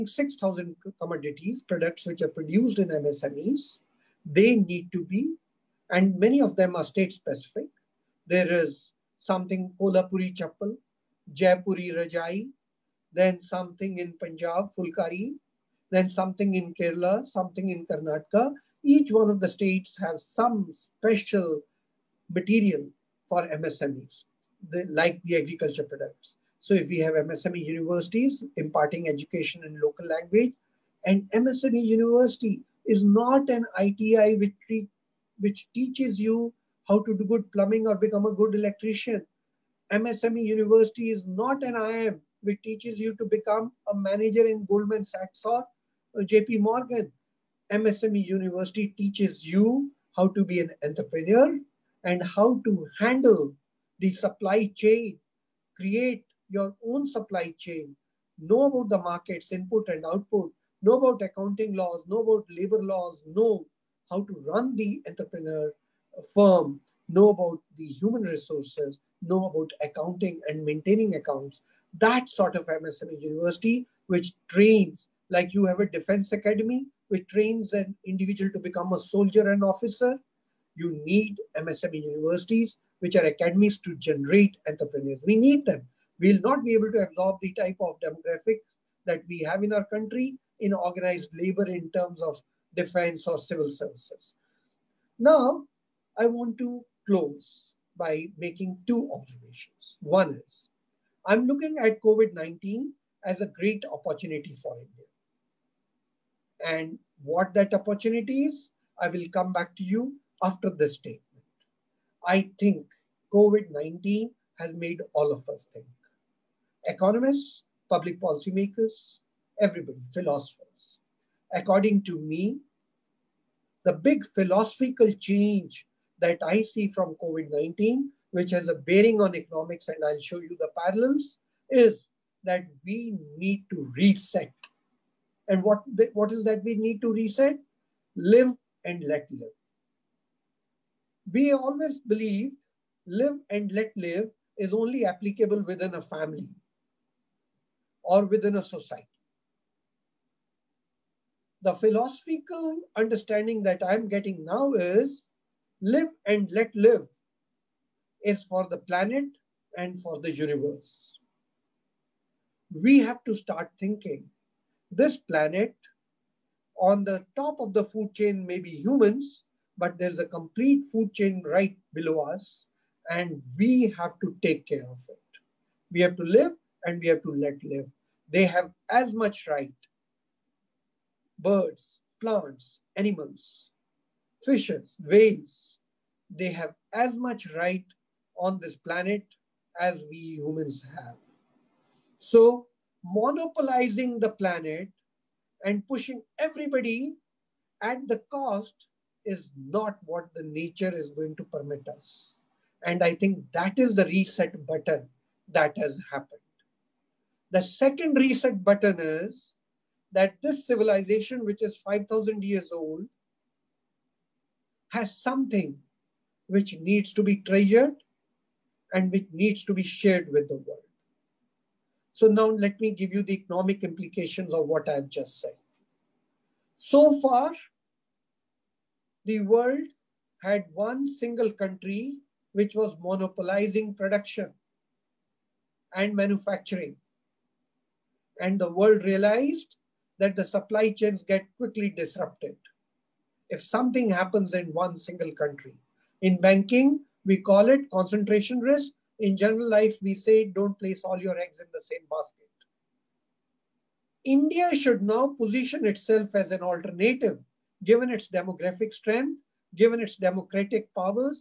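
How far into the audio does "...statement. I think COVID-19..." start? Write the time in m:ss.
1:50.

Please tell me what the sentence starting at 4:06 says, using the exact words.
In banking, we call it concentration risk in general life, we say don't place all your eggs in the same basket.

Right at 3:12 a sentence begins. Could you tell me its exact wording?
So monopolizing the planet and pushing everybody at the cost is not what the nature is going to permit us.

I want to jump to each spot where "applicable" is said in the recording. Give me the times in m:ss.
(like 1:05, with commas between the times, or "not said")
2:25.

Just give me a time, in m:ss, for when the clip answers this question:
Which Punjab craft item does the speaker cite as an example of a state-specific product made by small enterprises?
0:14.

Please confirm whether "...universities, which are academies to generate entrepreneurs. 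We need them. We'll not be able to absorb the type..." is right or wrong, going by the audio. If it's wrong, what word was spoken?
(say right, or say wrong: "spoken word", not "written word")
right.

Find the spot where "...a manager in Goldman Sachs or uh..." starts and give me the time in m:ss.
0:43.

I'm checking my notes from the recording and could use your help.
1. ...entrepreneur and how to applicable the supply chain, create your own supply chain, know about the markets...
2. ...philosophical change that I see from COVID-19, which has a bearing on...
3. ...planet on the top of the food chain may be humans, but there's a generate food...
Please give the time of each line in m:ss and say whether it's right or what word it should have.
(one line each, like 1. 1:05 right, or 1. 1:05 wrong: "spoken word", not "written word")
1. 0:50 wrong: "handle", not "applicable"
2. 2:04 right
3. 2:45 wrong: "complete", not "generate".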